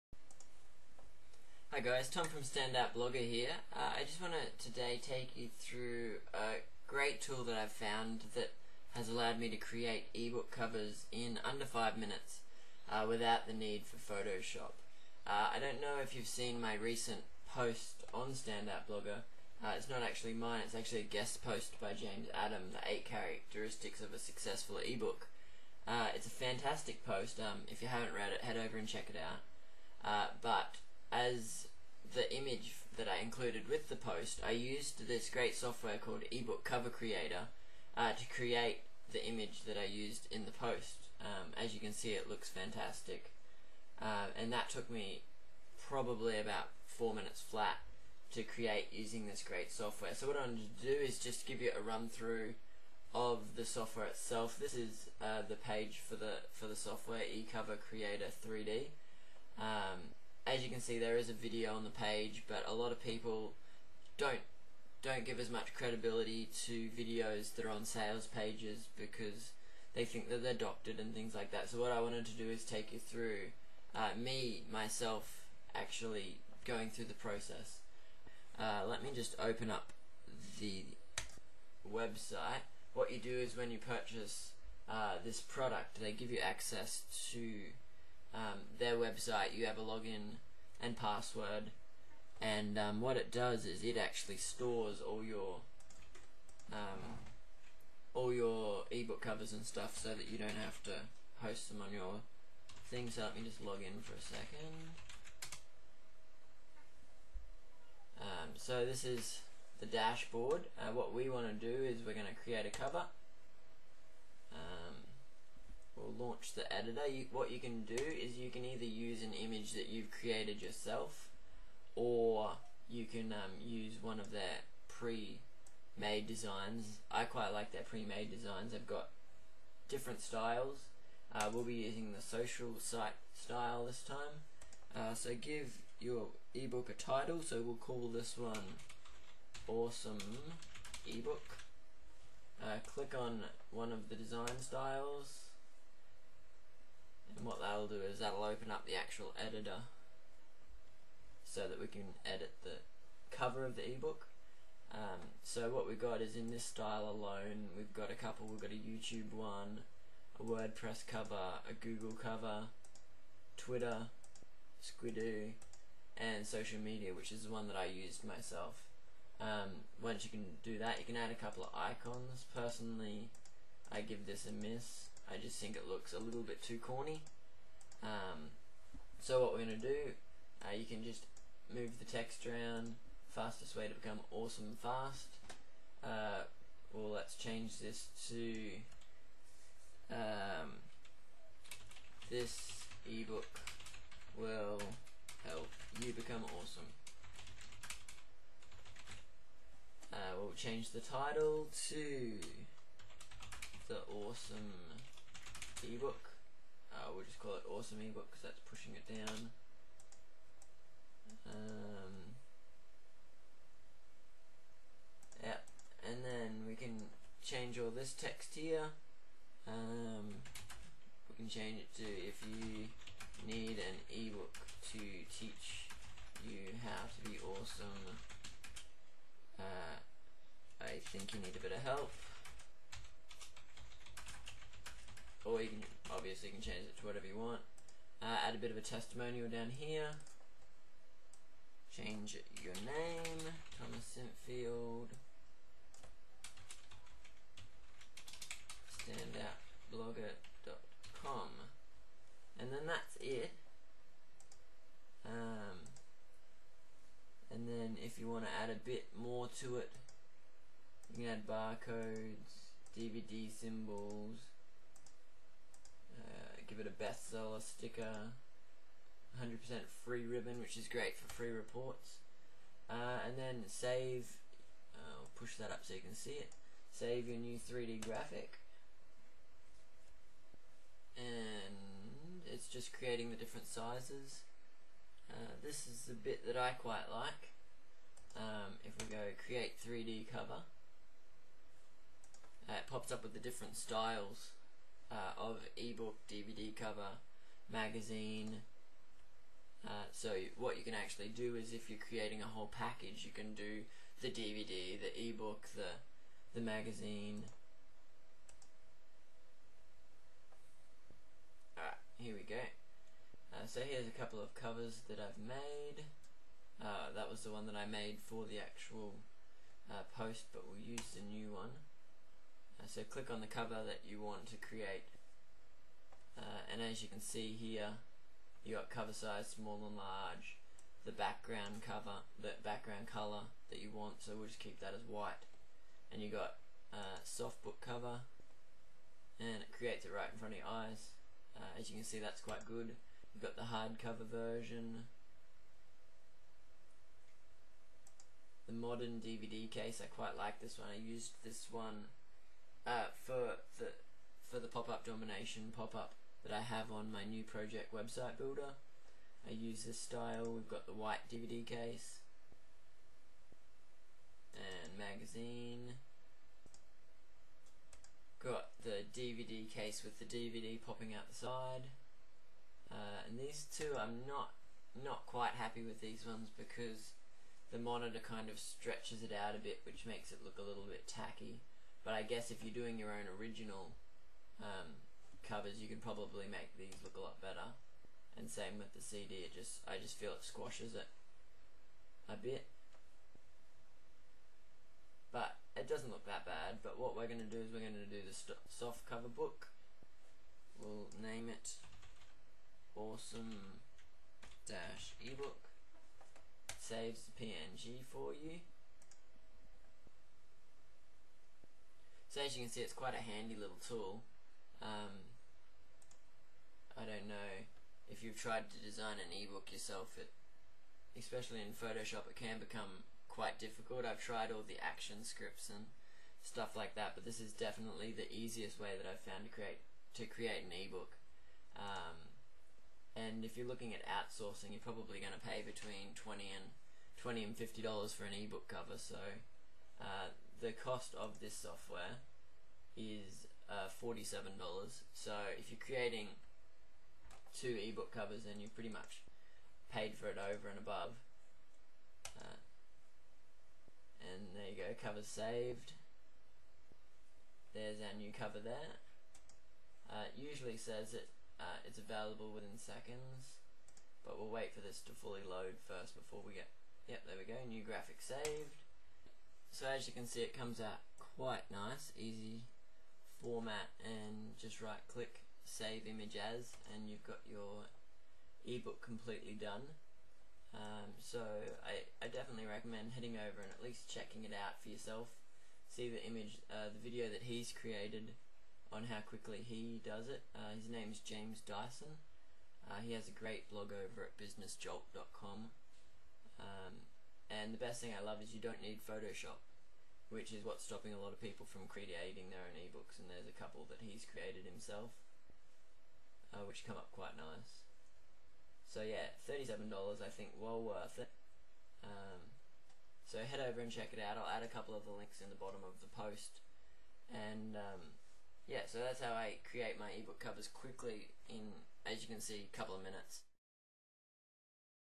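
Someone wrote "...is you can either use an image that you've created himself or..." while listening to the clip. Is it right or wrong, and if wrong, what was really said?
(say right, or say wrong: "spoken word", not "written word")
wrong: "yourself", not "himself".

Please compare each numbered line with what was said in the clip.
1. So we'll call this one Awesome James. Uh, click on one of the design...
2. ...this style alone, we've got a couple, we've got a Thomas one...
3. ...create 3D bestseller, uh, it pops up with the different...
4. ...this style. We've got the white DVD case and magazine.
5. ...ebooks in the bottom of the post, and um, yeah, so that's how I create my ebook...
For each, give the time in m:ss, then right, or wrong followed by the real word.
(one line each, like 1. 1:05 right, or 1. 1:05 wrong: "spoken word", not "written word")
1. 2:17 wrong: "Ebook", not "James"
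2. 2:36 wrong: "YouTube", not "Thomas"
3. 4:49 wrong: "cover", not "bestseller"
4. 5:59 right
5. 8:35 wrong: "links", not "ebooks".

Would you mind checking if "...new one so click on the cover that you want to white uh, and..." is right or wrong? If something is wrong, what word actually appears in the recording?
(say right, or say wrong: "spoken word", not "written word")
wrong: "create", not "white".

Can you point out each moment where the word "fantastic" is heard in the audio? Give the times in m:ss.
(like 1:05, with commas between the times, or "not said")
0:26, 0:42.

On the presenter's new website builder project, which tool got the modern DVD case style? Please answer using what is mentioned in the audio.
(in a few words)
pop-up domination.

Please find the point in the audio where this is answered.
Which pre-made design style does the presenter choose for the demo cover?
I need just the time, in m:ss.
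2:12.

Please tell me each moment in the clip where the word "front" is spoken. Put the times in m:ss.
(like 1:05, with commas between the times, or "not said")
5:40.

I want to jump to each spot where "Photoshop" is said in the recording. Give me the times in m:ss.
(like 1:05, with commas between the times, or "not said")
0:13, 7:01, 8:19.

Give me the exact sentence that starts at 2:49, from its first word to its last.
Um, once you can do that, you can add a couple of icons.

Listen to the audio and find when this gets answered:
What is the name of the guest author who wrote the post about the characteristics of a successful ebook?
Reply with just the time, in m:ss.
0:21.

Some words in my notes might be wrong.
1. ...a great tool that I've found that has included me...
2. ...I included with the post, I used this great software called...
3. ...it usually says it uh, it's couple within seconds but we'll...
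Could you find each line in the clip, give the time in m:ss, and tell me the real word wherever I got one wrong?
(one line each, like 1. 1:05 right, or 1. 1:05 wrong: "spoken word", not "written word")
1. 0:06 wrong: "allowed", not "included"
2. 0:33 right
3. 7:40 wrong: "available", not "couple".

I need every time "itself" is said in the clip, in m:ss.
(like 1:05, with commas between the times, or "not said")
0:54.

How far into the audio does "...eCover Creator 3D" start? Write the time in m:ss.
0:57.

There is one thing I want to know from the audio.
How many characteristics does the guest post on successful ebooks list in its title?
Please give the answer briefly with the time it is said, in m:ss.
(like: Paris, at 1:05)
8, at 0:22.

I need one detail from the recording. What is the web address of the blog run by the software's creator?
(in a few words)
businessjolt.com.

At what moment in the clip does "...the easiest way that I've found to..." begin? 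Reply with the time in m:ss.
7:08.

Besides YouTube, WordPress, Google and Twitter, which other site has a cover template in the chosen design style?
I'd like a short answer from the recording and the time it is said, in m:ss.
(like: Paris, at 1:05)
Squidoo, at 2:44.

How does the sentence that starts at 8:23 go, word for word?
And there's a couple that he's created himself, uh, which come up quite nice.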